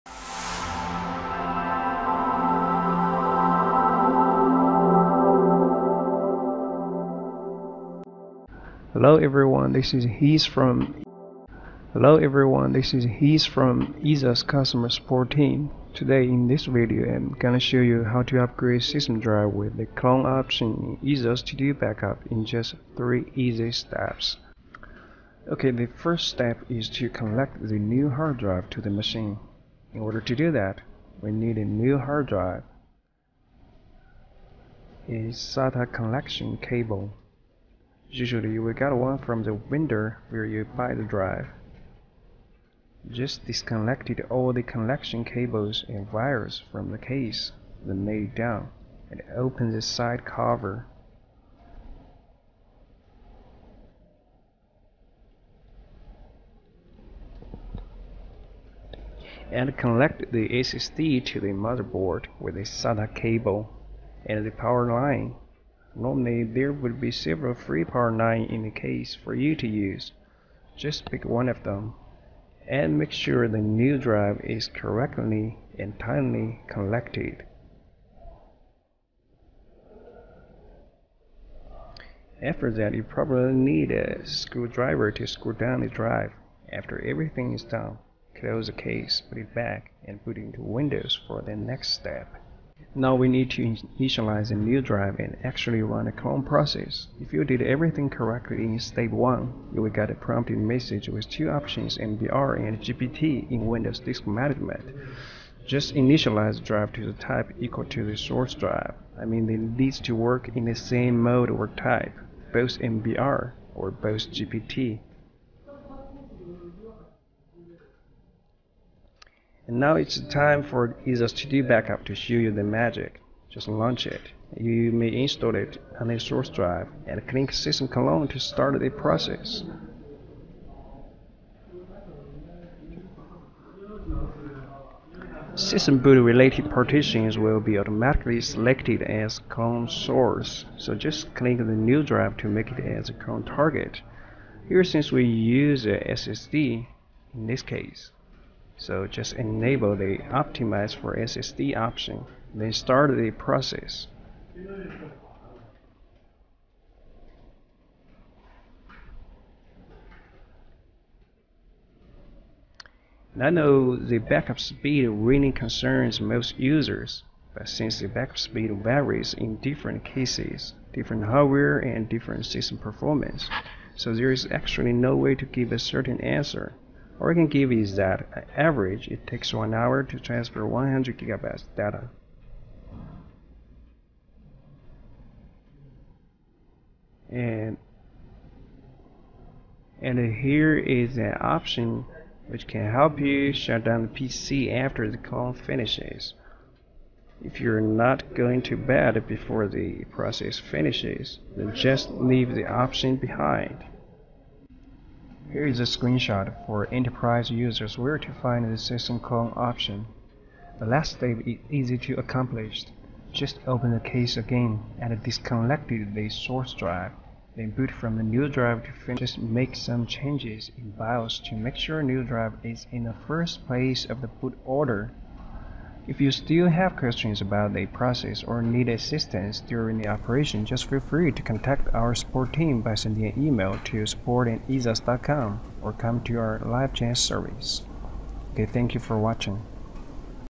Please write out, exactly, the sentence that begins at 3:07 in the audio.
And and here is an option which can help you shut down the PC after the call finishes.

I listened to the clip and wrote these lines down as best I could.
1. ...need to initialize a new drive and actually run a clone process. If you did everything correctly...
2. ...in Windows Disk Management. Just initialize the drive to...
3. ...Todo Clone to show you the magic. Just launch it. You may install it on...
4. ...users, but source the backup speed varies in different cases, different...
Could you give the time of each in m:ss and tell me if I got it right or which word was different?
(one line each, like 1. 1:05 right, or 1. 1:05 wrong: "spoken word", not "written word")
1. 1:33 right
2. 1:43 right
3. 2:01 wrong: "Backup", not "Clone"
4. 2:46 wrong: "since", not "source".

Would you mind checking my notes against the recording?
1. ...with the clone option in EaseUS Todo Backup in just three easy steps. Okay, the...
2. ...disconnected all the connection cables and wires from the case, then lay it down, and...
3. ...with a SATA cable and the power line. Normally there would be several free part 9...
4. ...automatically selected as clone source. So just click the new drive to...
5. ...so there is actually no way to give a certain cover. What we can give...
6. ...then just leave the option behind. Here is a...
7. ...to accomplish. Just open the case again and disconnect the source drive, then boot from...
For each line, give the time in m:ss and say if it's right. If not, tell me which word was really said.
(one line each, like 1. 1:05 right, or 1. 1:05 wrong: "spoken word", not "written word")
1. 0:19 right
2. 0:43 right
3. 1:02 right
4. 2:17 right
5. 2:53 wrong: "answer", not "cover"
6. 3:21 right
7. 3:31 right.